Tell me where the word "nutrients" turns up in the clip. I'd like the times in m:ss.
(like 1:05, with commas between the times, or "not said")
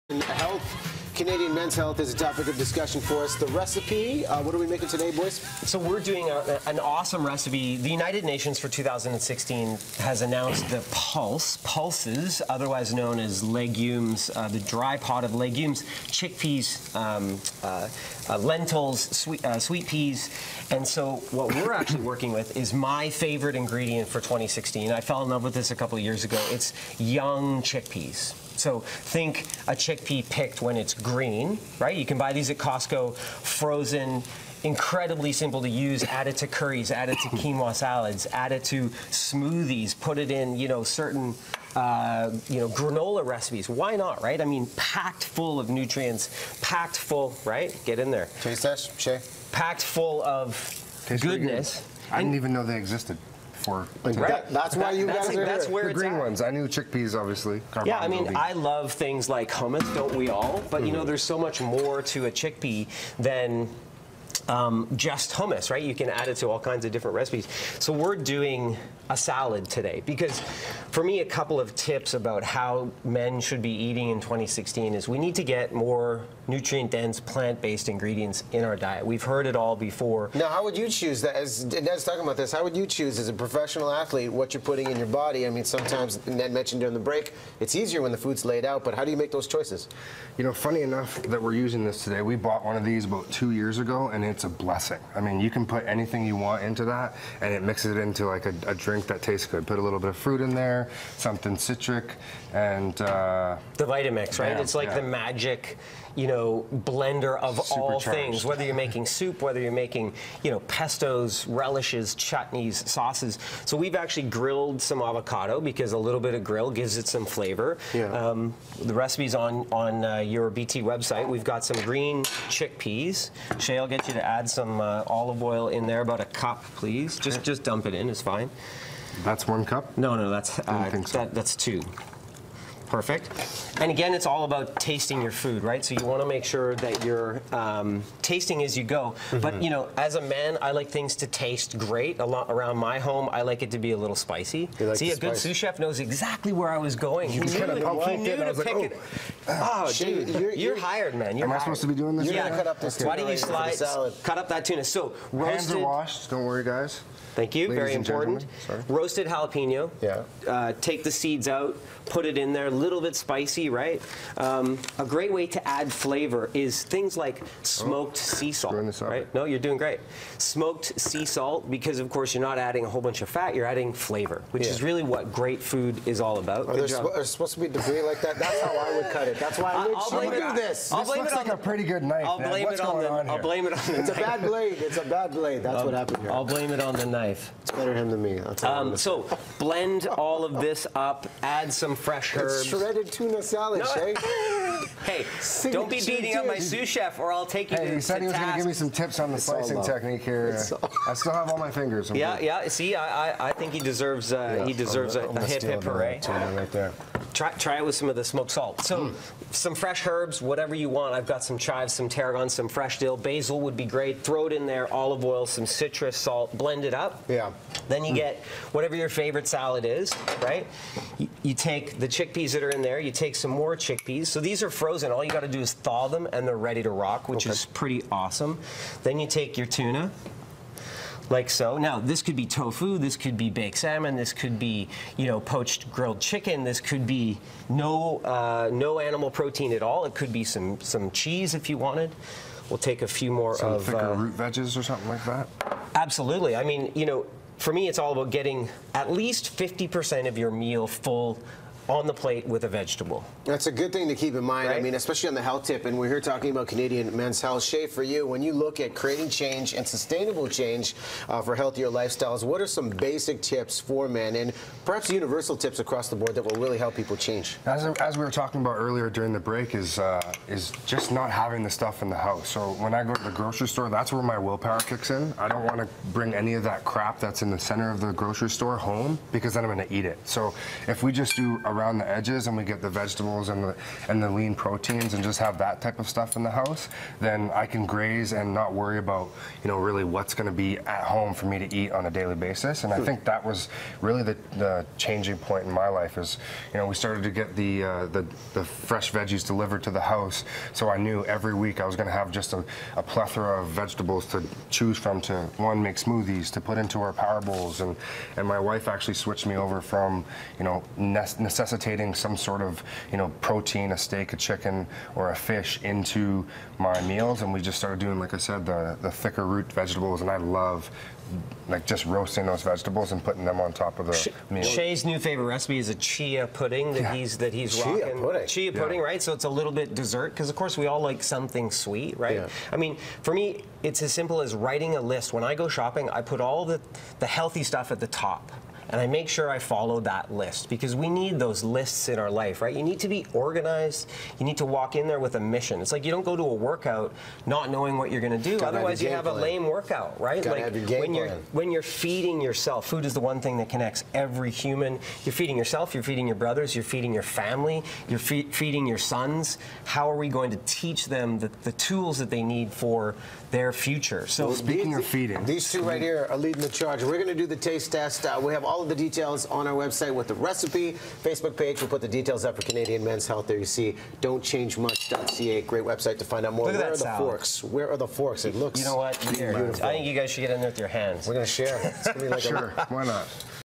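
0:45, 1:16.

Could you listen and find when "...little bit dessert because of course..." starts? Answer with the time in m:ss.
5:29.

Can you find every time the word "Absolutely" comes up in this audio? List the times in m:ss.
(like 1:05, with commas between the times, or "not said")
4:05.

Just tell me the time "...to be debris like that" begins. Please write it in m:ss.
2:57.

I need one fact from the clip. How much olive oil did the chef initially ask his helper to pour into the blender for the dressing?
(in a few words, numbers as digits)
a cup.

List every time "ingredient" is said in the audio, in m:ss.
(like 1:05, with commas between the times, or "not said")
0:23, 1:17.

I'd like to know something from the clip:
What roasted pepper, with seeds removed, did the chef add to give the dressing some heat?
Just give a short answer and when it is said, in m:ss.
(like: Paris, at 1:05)
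jalapeno, at 2:38.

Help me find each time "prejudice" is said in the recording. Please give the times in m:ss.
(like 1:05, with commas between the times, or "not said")
not said.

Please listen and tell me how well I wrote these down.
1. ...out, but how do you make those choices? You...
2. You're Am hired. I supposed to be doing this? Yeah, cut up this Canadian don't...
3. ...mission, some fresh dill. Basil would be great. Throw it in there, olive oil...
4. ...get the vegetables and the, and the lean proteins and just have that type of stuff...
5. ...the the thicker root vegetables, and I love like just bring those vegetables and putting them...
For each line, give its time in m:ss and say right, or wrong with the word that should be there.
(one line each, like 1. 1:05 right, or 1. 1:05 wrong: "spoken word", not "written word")
1. 1:28 right
2. 2:31 wrong: "Why", not "Canadian"
3. 3:32 wrong: "tarragon", not "mission"
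4. 4:42 right
5. 5:18 wrong: "roasting", not "bring".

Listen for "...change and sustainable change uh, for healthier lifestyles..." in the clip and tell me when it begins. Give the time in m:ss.
4:19.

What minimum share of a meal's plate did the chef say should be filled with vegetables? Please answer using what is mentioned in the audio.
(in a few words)
50%.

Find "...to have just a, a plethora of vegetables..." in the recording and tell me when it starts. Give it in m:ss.
5:02.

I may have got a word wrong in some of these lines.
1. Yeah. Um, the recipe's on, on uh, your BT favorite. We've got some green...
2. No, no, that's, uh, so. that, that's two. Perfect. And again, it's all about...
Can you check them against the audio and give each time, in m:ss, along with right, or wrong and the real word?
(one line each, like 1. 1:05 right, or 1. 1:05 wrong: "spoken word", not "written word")
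1. 1:57 wrong: "website", not "favorite"
2. 2:09 right.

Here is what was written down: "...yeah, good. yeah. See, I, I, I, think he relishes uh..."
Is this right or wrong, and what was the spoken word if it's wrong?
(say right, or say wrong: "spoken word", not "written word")
wrong: "deserves", not "relishes".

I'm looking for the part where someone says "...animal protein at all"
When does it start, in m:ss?
3:58.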